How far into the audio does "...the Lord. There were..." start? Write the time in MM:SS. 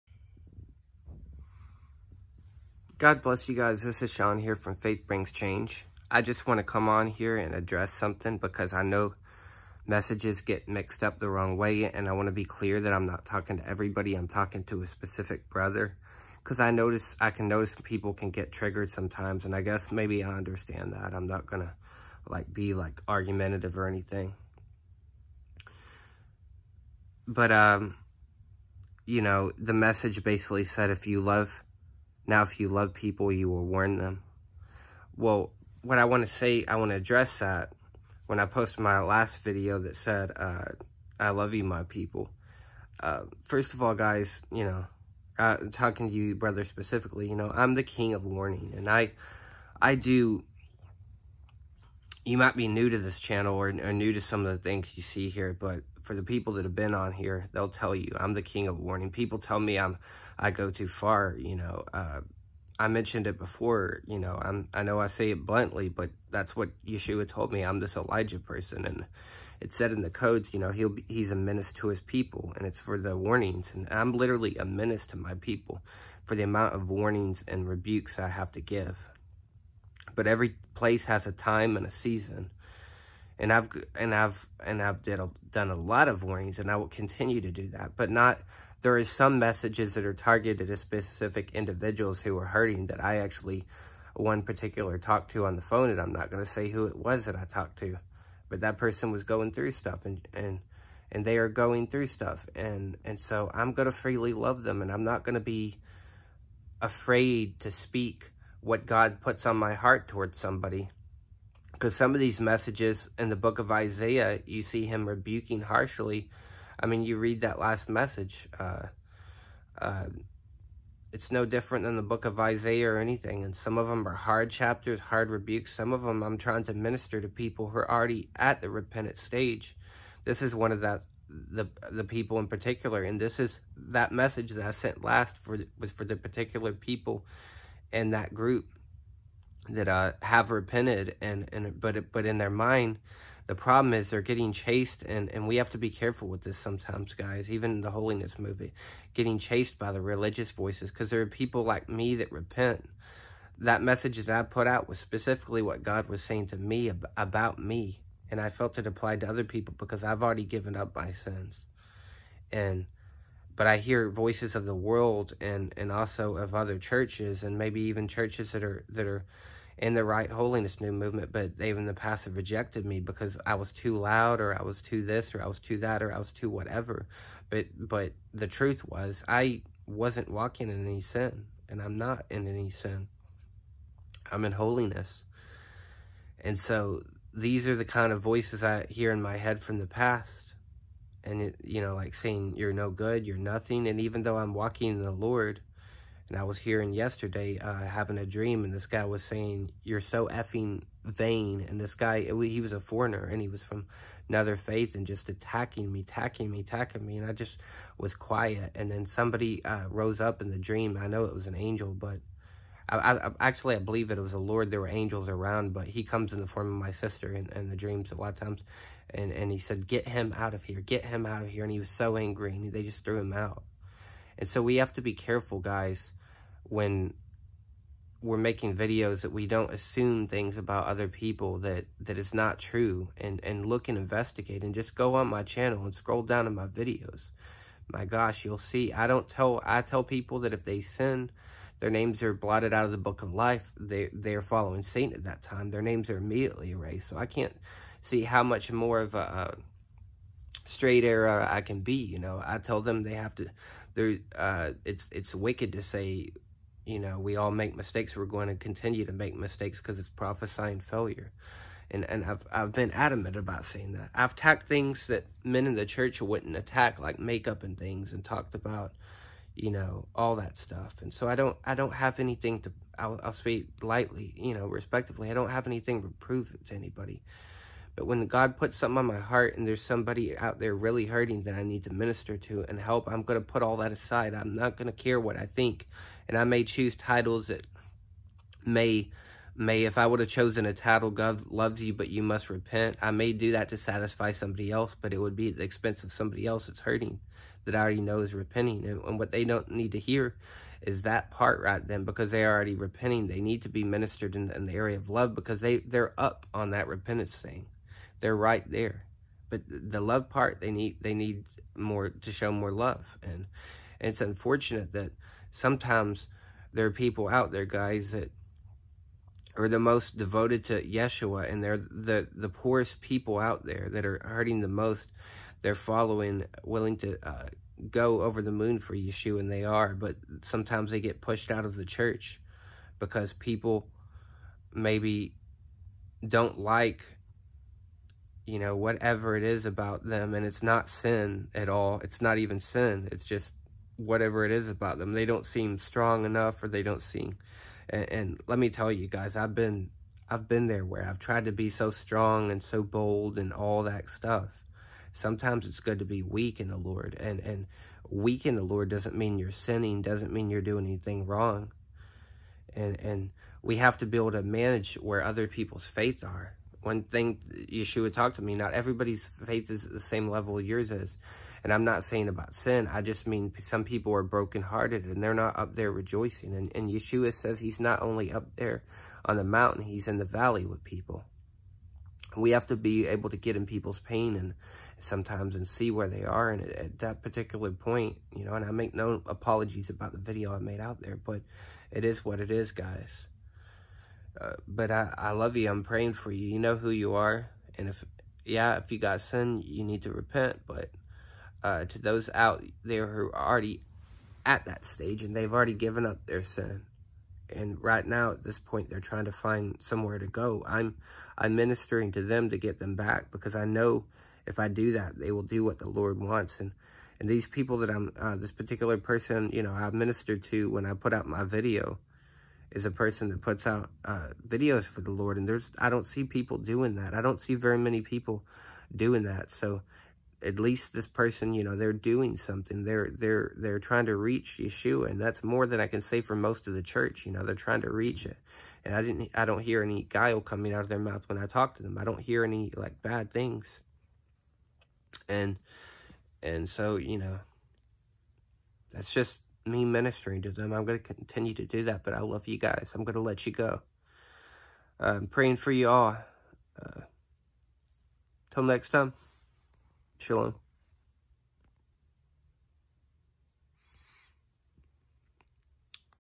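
03:34.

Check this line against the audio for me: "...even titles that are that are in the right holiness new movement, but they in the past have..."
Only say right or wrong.
wrong.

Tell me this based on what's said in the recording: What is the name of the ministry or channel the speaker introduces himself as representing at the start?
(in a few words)
Faith Brings Change.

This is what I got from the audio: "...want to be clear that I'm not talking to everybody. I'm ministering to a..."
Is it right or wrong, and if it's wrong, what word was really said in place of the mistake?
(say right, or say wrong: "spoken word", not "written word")
wrong: "talking", not "ministering".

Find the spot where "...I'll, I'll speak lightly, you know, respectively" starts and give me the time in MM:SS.
04:32.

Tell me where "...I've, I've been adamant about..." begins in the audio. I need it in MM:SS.
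04:22.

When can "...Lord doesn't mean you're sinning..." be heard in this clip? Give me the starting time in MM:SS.
05:58.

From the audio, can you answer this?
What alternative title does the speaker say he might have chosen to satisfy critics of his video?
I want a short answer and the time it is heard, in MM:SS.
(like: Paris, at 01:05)
God loves you, but you must repent, at 04:51.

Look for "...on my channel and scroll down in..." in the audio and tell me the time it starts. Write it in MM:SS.
03:55.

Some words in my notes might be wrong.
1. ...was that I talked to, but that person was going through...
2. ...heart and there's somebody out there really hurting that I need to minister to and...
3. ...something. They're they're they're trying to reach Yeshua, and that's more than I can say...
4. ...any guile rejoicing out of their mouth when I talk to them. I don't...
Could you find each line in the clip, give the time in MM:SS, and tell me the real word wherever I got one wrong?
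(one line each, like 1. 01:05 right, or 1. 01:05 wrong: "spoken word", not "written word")
1. 01:36 right
2. 04:39 right
3. 07:12 right
4. 07:19 wrong: "coming", not "rejoicing".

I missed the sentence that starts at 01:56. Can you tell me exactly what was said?
I mean, you read that last message.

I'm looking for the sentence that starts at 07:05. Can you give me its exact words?
And there's I don't see people doing that.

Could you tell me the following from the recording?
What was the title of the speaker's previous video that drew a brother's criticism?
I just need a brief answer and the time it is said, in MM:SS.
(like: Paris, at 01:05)
I love you, my people, at 00:41.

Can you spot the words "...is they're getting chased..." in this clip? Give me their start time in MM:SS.
02:23.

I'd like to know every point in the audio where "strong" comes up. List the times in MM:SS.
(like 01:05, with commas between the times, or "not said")
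05:45, 05:51.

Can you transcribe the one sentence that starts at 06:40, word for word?
But uh, to those out there who are already at that stage and they've already given up their sin.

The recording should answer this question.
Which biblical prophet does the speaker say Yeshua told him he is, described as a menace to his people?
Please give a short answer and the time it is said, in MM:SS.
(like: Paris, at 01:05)
Elijah, at 01:07.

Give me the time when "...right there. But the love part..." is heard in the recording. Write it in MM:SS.
05:08.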